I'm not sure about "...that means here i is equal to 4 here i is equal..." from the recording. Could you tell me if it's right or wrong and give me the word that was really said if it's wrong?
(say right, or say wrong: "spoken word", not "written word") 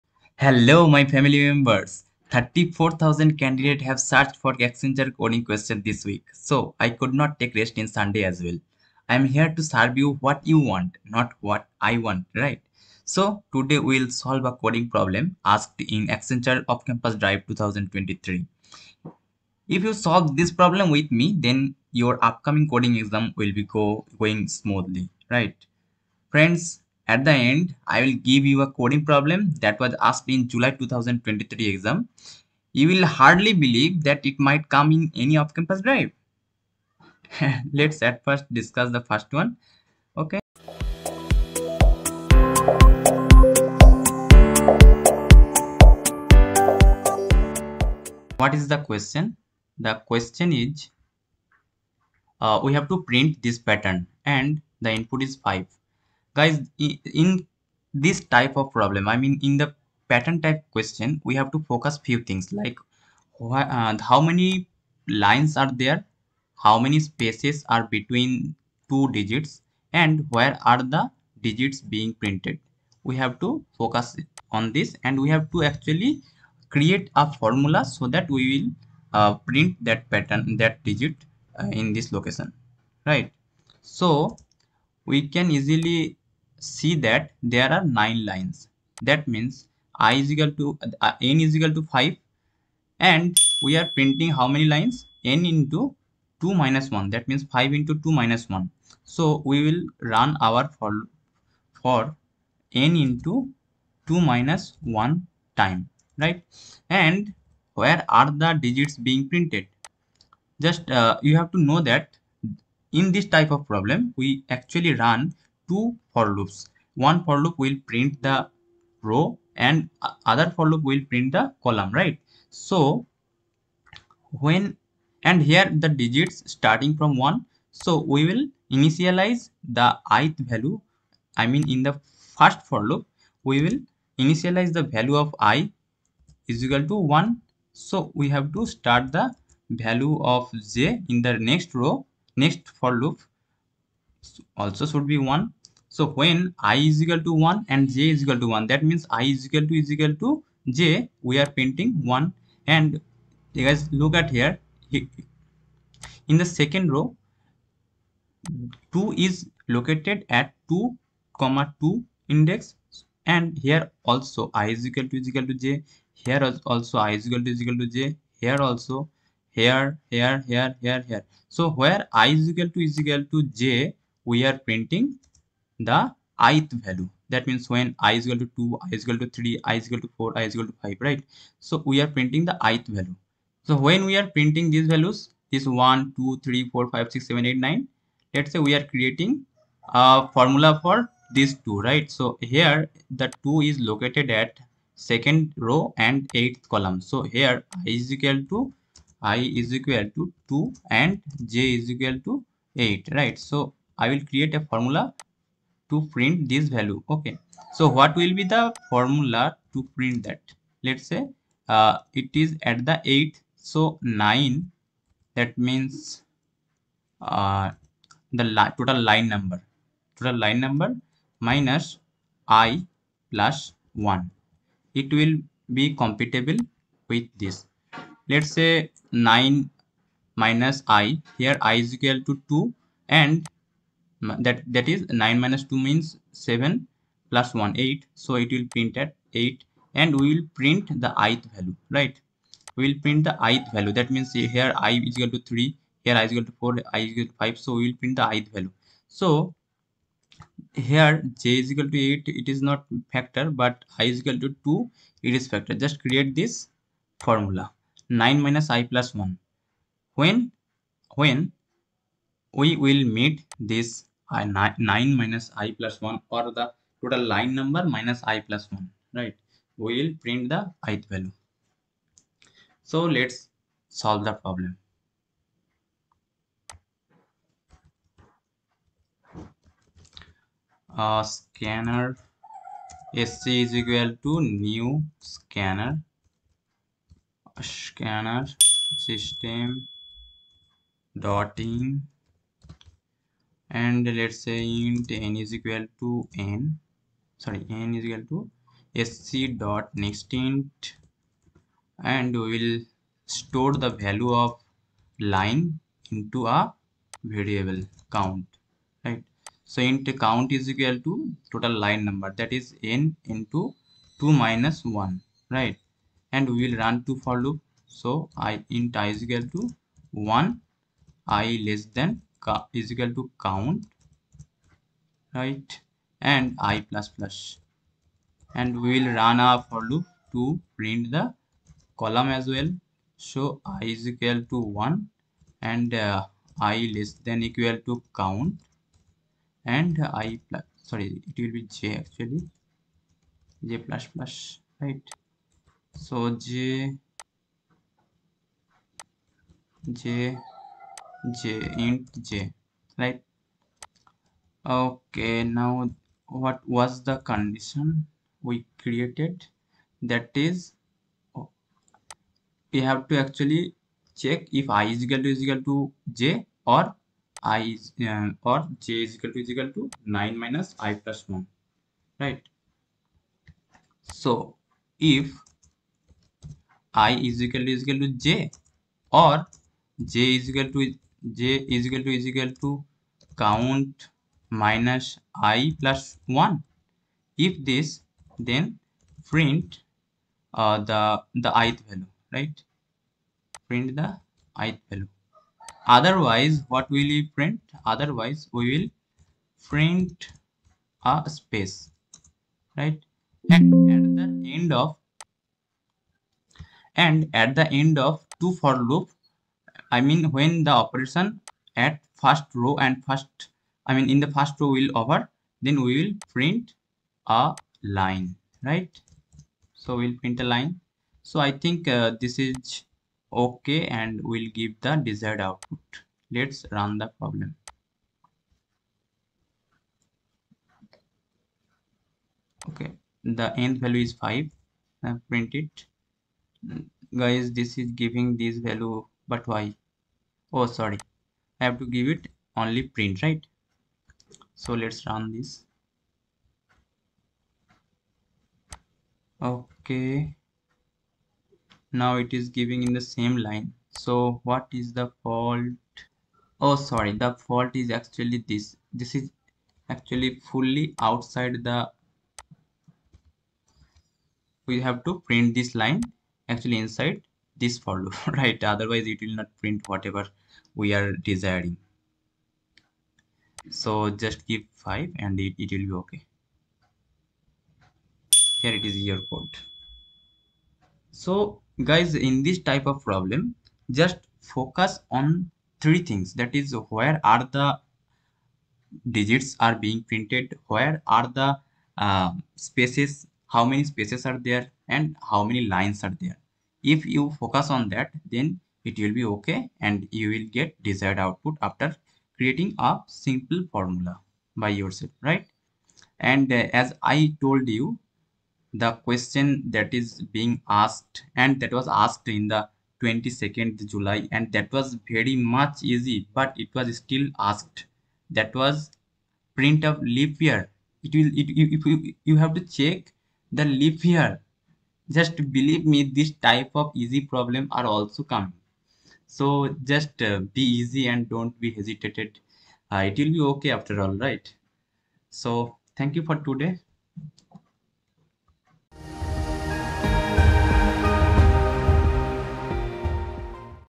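wrong: "3", not "4".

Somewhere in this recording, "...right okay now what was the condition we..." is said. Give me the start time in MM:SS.
05:52.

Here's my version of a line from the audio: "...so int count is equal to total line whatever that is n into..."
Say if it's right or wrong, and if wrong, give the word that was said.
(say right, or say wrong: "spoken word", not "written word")
wrong: "number", not "whatever".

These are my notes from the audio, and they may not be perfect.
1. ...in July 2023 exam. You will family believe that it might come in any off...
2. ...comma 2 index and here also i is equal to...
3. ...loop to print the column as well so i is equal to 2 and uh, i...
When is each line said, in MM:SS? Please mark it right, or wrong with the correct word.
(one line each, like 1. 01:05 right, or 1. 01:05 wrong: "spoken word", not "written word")
1. 00:30 wrong: "hardly", not "family"
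2. 02:41 right
3. 05:29 wrong: "1", not "2".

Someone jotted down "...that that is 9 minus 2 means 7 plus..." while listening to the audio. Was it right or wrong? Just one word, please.
right.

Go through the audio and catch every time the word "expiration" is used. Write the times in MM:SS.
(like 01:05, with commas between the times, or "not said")
not said.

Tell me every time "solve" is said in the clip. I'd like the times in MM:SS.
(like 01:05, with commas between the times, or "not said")
00:14, 00:19, 04:33.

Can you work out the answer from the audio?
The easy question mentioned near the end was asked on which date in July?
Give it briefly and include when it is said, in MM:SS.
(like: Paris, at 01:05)
22nd, at 08:33.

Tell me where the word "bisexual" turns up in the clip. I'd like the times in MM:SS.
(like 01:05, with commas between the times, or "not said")
not said.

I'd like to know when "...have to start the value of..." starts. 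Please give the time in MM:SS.
02:18.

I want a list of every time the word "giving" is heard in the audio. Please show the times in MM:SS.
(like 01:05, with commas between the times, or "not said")
07:17, 07:32.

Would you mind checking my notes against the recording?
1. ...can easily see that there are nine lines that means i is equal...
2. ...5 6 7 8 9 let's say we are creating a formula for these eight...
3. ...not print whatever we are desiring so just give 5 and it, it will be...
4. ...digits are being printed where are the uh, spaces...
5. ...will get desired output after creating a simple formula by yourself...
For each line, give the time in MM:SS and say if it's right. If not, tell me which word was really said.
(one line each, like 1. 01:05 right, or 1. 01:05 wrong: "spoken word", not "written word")
1. 01:25 right
2. 03:06 wrong: "two", not "eight"
3. 07:49 right
4. 08:09 right
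5. 08:20 right.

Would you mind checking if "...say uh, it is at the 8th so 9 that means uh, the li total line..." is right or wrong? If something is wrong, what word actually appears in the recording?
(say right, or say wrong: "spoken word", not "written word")
right.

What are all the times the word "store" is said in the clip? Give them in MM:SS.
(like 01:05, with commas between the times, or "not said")
05:03.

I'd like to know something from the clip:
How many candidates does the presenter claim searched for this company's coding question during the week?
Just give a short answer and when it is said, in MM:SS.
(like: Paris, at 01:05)
34,000, at 00:02.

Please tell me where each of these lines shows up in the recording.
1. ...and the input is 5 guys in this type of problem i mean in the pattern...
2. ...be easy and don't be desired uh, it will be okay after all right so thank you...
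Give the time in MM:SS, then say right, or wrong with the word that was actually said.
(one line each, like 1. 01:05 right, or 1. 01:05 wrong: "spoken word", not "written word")
1. 00:54 right
2. 08:50 wrong: "hesitated", not "desired".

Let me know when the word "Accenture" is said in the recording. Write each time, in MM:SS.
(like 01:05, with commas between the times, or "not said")
00:04, 00:16.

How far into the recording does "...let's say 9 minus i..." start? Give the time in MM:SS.
03:48.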